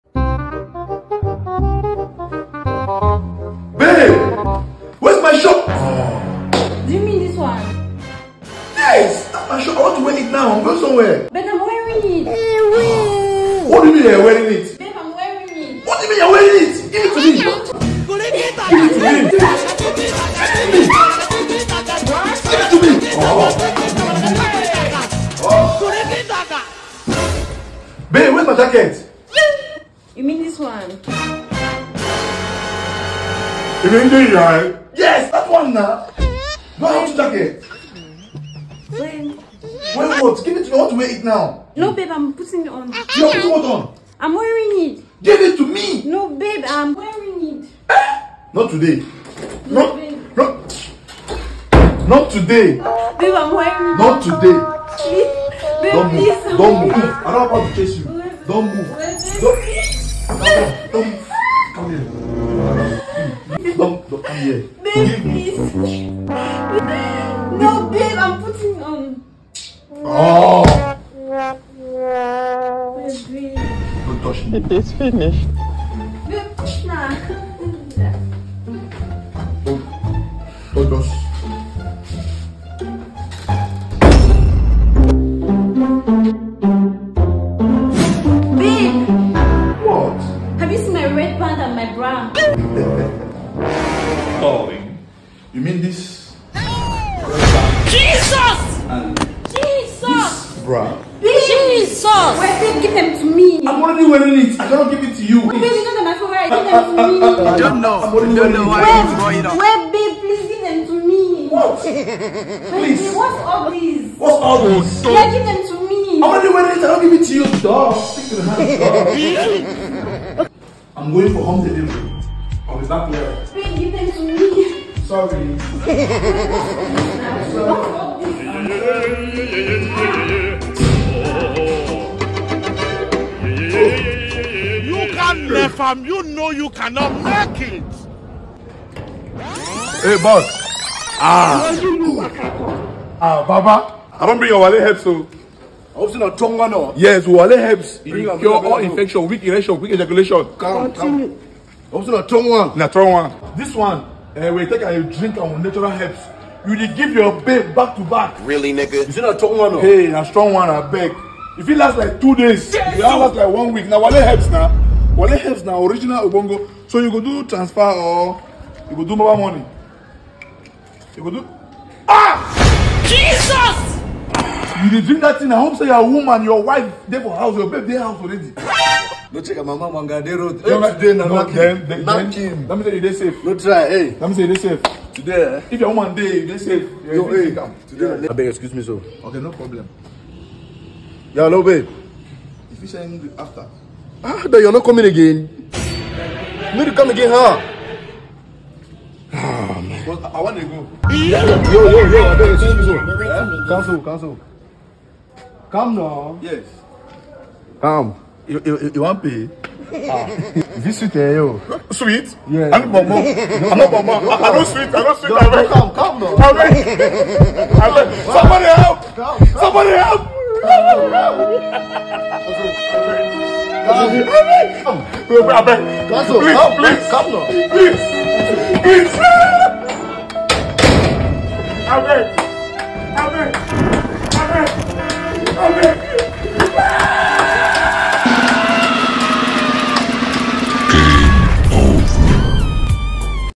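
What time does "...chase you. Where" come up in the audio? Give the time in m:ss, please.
0:57.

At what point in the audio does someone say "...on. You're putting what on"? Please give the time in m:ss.
0:42.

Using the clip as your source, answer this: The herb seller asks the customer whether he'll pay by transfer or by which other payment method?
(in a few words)
mobile money.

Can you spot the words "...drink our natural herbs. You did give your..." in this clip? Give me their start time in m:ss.
2:35.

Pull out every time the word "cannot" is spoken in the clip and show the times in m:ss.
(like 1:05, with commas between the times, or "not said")
1:44, 2:16.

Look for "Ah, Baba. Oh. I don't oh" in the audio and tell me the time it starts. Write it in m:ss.
2:23.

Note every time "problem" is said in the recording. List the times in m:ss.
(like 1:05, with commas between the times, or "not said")
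3:09.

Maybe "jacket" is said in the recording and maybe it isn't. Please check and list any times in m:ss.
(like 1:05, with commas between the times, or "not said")
0:28, 0:37.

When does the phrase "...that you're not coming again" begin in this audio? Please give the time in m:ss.
3:14.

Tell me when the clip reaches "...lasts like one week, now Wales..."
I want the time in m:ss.
2:43.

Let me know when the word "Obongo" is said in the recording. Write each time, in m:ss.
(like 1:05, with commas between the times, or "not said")
2:46.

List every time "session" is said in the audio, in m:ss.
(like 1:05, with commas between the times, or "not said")
not said.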